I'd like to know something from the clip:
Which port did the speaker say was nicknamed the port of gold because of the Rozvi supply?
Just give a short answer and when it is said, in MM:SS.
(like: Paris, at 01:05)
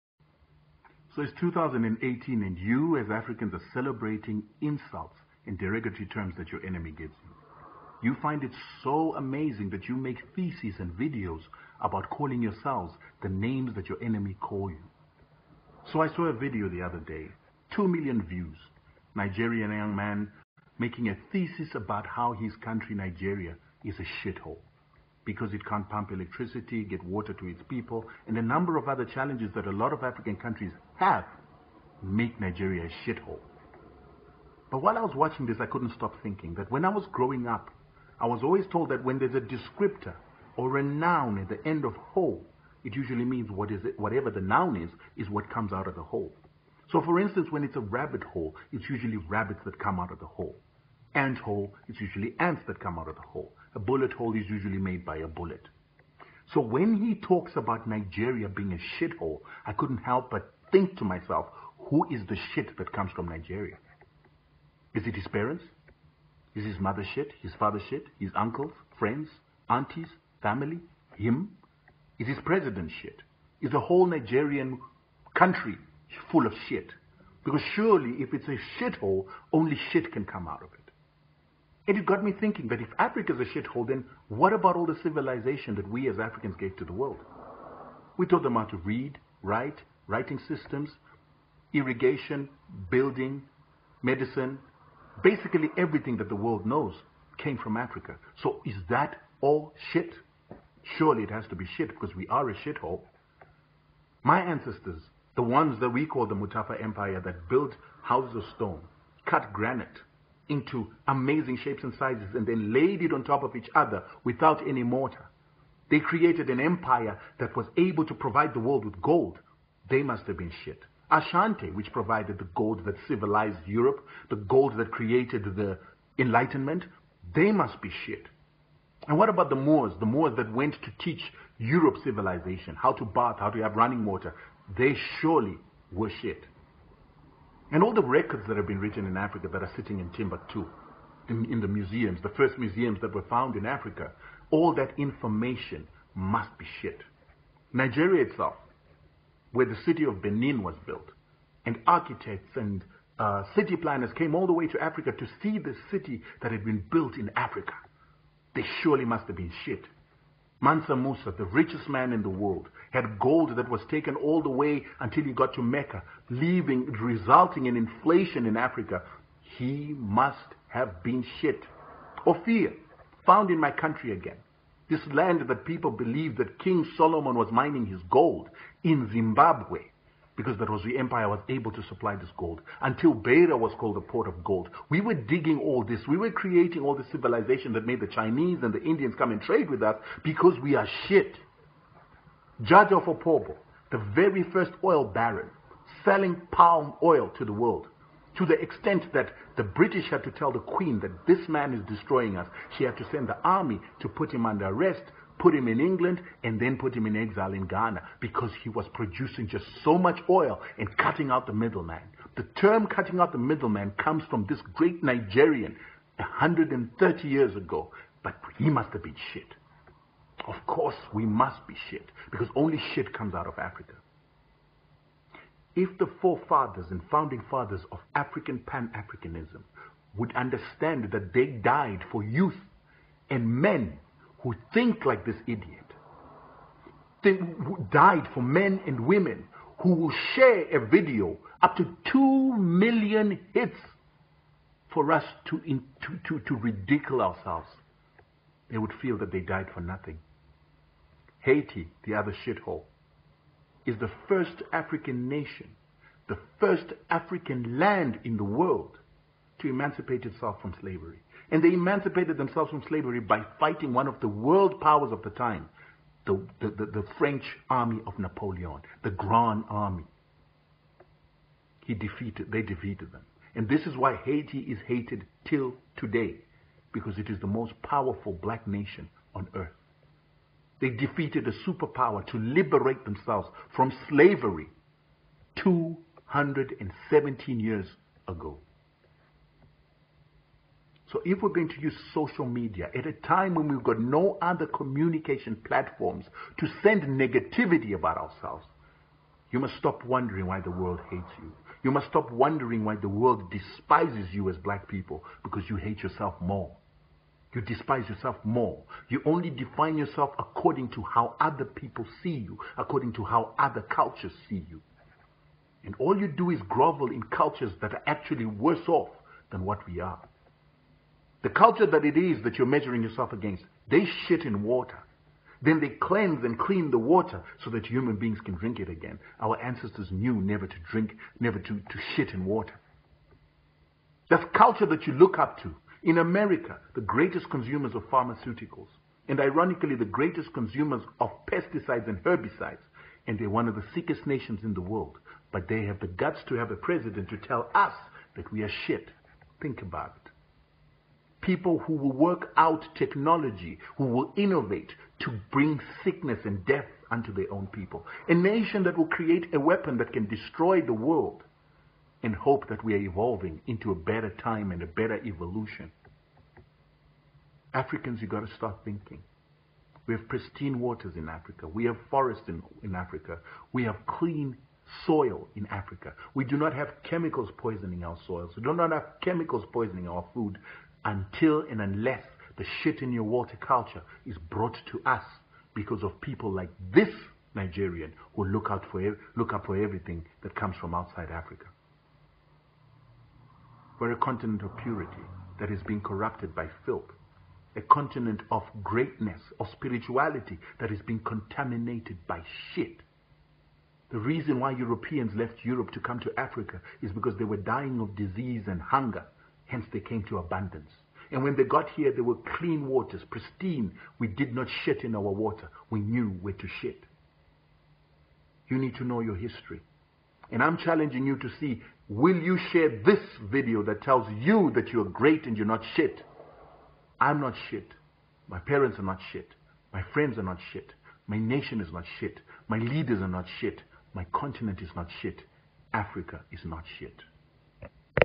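Beira, at 03:03.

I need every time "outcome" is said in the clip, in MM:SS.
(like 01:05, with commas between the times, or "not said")
not said.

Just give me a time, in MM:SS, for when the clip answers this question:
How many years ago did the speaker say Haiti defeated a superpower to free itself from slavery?
04:45.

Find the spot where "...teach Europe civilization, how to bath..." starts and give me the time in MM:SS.
02:10.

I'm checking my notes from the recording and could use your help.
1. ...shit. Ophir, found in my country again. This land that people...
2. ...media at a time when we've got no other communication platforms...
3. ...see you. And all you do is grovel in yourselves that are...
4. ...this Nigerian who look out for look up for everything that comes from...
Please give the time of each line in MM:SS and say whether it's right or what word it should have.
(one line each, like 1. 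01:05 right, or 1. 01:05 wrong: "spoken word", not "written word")
1. 02:51 right
2. 04:52 right
3. 05:14 wrong: "cultures", not "yourselves"
4. 06:26 right.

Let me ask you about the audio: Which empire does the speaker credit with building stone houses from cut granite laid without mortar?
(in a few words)
Mutapa Empire.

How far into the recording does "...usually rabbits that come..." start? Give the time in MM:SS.
00:48.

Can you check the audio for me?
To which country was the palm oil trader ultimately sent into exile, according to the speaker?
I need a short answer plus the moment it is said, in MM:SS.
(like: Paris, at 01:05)
Ghana, at 03:27.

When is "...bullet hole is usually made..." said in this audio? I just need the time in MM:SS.
00:53.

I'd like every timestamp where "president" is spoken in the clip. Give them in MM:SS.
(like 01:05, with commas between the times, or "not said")
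01:12, 05:46.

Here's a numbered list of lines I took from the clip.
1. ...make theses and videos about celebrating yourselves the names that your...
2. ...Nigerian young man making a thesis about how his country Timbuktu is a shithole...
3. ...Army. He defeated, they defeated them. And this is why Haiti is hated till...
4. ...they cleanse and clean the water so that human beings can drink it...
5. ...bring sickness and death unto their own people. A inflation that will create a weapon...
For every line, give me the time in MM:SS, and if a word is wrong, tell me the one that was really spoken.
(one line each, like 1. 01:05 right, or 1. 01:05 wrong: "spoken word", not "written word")
1. 00:09 wrong: "calling", not "celebrating"
2. 00:19 wrong: "Nigeria", not "Timbuktu"
3. 04:29 right
4. 05:25 right
5. 05:55 wrong: "nation", not "inflation".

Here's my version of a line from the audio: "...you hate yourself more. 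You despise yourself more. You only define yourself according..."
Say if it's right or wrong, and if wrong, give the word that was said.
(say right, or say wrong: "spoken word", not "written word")
right.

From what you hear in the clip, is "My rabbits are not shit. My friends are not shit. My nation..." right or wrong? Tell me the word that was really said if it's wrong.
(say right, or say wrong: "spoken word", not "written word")
wrong: "parents", not "rabbits".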